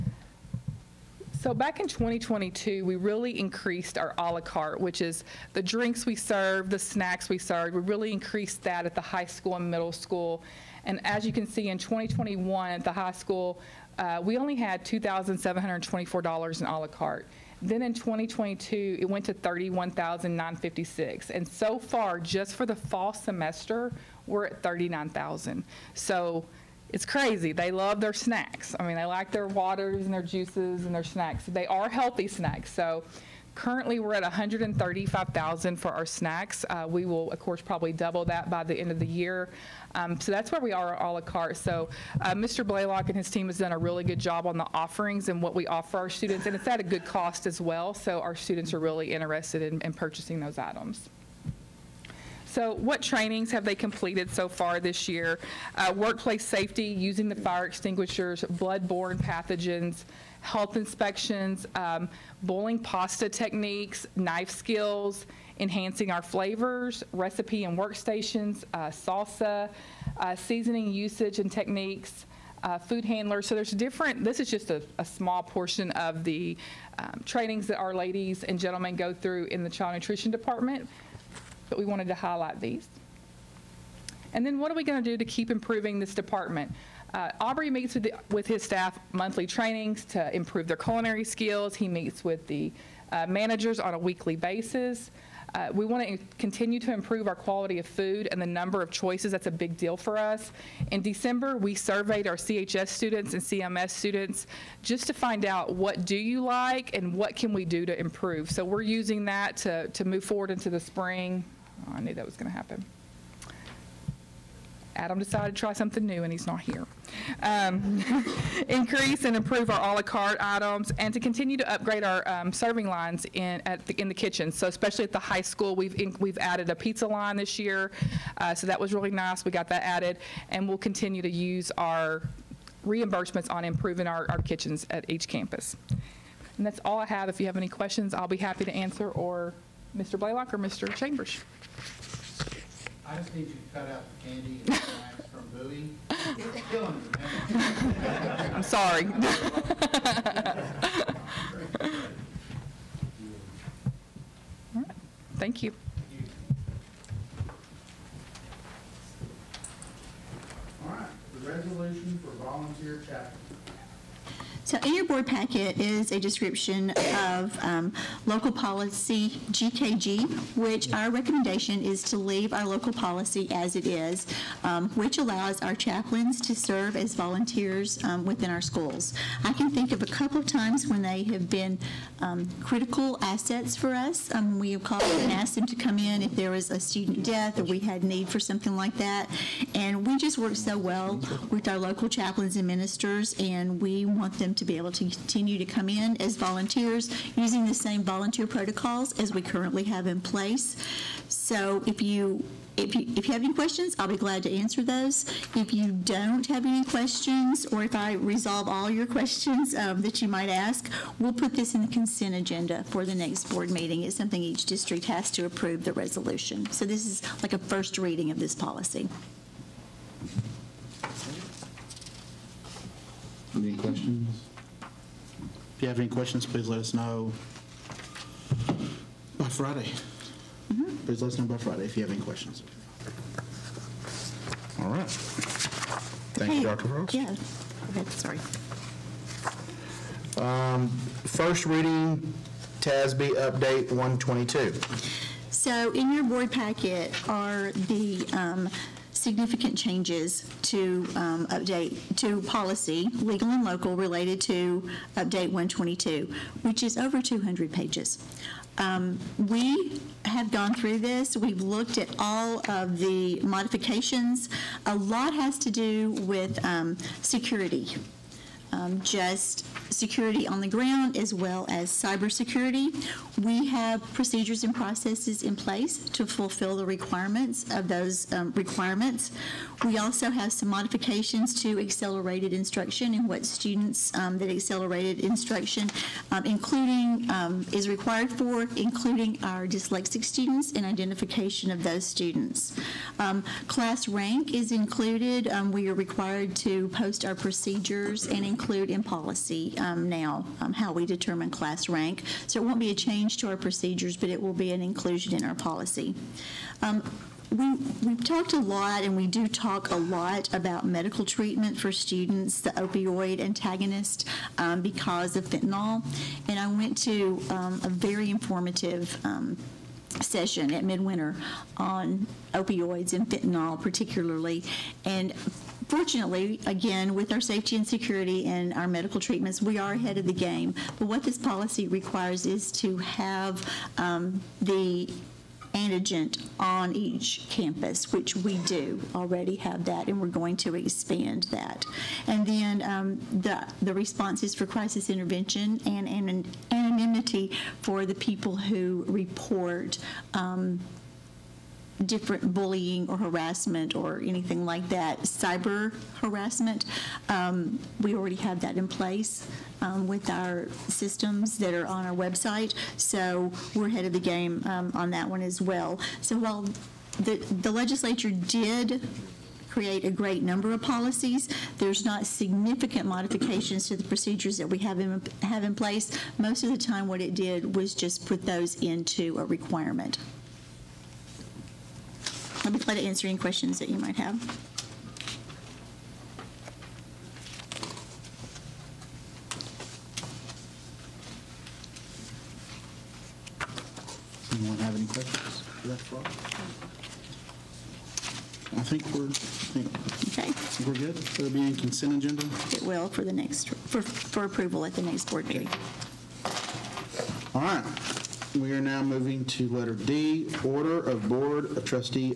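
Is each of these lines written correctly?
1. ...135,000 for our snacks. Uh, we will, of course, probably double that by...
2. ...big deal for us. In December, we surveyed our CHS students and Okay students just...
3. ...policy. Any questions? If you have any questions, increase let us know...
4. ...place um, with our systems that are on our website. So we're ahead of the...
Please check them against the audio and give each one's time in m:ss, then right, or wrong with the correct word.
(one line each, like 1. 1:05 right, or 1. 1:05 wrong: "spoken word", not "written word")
1. 0:34 right
2. 1:39 wrong: "CMS", not "Okay"
3. 3:38 wrong: "please", not "increase"
4. 5:58 right.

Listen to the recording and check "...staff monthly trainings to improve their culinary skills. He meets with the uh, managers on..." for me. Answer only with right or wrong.
right.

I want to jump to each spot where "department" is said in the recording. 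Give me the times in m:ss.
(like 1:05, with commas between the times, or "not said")
1:20, 1:26.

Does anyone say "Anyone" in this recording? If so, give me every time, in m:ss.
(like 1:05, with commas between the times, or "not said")
6:34.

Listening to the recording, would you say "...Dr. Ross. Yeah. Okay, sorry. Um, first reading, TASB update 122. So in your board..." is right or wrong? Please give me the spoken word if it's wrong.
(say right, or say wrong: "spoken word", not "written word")
right.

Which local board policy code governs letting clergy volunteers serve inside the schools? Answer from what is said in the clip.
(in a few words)
GKG.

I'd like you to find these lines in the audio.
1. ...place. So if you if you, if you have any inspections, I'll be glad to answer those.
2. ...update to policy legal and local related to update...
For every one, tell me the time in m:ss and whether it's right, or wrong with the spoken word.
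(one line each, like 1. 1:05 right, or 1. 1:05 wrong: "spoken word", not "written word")
1. 3:20 wrong: "questions", not "inspections"
2. 4:11 right.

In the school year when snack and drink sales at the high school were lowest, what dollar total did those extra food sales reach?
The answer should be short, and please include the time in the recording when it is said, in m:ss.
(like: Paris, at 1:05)
$2,724, at 0:14.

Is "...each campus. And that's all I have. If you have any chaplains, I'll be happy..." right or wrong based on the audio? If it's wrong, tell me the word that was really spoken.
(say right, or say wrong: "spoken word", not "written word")
wrong: "questions", not "chaplains".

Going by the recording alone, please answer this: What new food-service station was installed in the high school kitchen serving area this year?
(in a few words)
pizza line.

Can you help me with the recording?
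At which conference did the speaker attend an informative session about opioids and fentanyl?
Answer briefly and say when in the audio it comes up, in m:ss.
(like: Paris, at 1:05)
midwinter, at 5:20.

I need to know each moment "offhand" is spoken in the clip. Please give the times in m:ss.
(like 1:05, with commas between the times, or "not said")
not said.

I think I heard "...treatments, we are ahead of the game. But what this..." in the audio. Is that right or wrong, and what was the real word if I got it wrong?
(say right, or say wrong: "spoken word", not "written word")
right.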